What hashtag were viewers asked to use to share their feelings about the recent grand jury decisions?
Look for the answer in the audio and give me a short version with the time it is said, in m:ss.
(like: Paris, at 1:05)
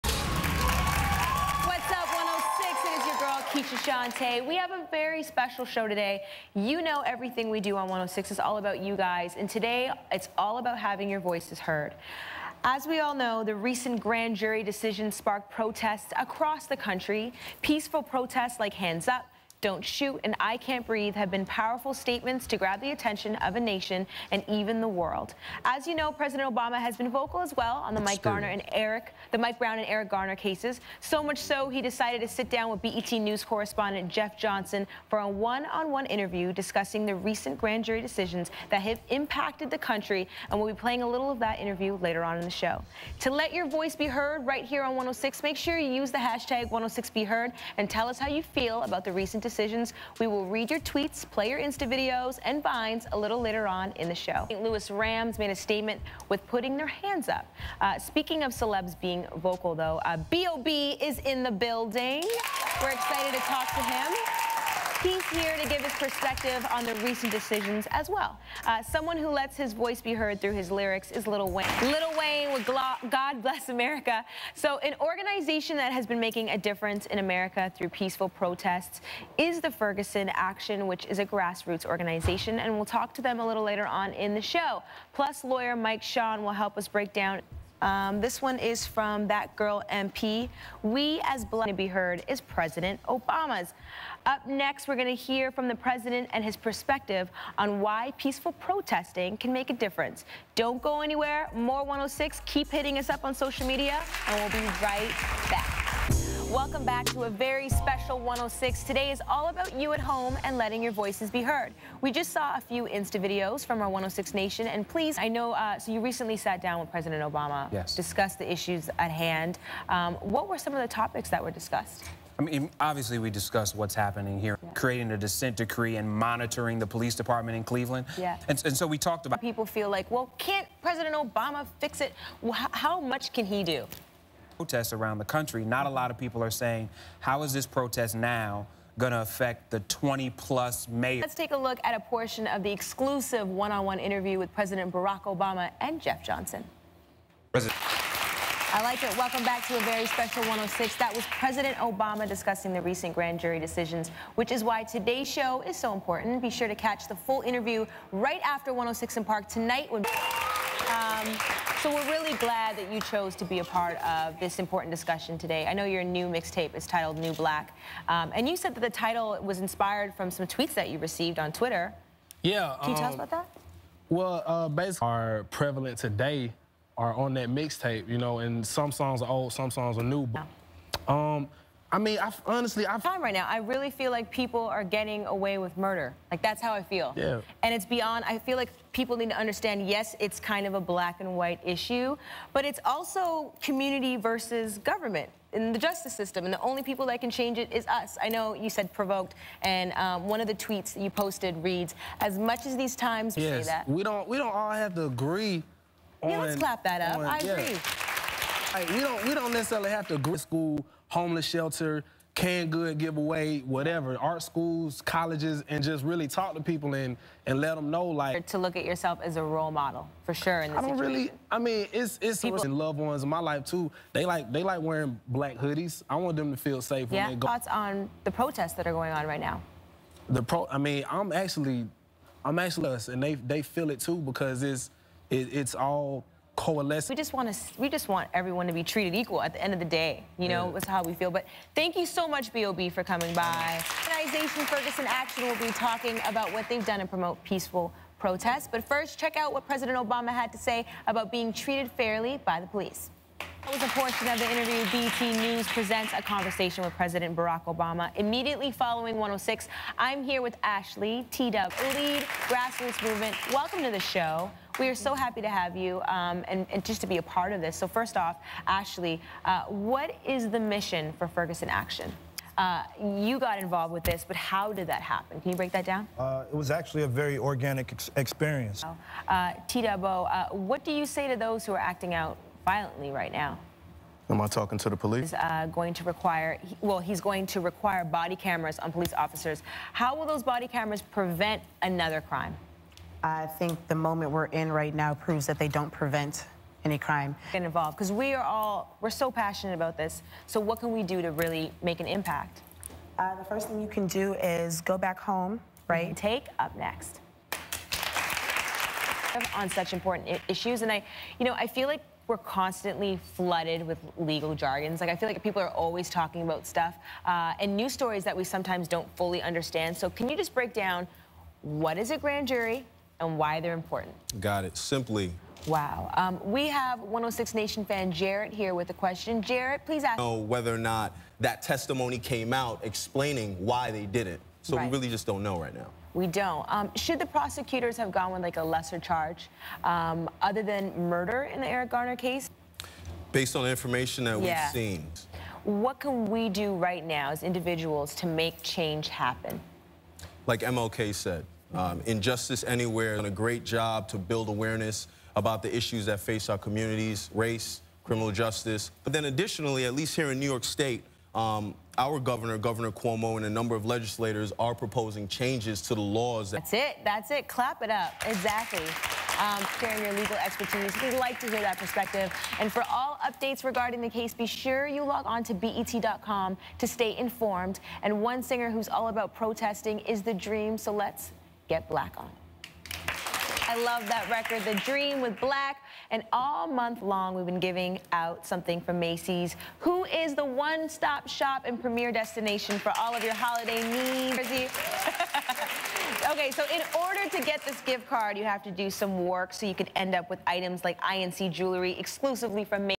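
#106BeHeard, at 0:46.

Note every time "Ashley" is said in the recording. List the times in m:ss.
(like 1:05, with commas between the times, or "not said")
4:20, 4:28.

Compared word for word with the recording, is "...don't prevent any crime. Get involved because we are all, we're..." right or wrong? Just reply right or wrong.
right.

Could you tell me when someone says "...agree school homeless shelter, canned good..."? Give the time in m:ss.
3:30.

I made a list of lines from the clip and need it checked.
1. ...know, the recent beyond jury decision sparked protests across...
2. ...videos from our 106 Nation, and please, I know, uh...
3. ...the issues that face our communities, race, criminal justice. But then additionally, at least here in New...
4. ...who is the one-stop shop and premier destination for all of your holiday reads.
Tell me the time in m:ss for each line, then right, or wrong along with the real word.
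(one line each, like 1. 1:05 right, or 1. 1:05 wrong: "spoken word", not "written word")
1. 0:13 wrong: "grand", not "beyond"
2. 1:53 right
3. 5:55 right
4. 6:29 wrong: "needs", not "reads".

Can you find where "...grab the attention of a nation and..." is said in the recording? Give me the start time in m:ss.
0:22.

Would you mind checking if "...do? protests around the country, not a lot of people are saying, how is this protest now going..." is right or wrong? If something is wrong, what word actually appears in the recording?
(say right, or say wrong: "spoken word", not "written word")
right.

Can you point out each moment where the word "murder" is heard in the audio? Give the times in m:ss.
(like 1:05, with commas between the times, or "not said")
3:05, 5:41.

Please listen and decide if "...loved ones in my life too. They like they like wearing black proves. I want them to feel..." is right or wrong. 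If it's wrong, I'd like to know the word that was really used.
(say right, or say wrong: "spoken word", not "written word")
wrong: "hoodies", not "proves".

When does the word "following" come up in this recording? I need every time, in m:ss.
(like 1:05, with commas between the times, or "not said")
4:18.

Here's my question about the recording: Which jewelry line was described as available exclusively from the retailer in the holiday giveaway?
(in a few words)
INC.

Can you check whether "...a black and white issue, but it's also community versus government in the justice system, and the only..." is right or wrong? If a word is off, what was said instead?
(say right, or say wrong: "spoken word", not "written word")
right.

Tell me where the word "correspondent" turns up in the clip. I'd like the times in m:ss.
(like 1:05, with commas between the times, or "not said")
0:33.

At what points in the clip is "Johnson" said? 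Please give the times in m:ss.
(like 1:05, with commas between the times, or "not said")
0:34, 2:26.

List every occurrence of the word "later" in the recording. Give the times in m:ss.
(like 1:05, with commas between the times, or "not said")
0:42, 0:53, 1:23.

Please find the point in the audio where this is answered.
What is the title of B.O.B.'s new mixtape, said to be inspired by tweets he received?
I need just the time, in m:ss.
2:47.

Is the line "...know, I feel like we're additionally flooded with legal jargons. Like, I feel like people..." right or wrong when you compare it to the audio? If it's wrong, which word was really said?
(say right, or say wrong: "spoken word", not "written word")
wrong: "constantly", not "additionally".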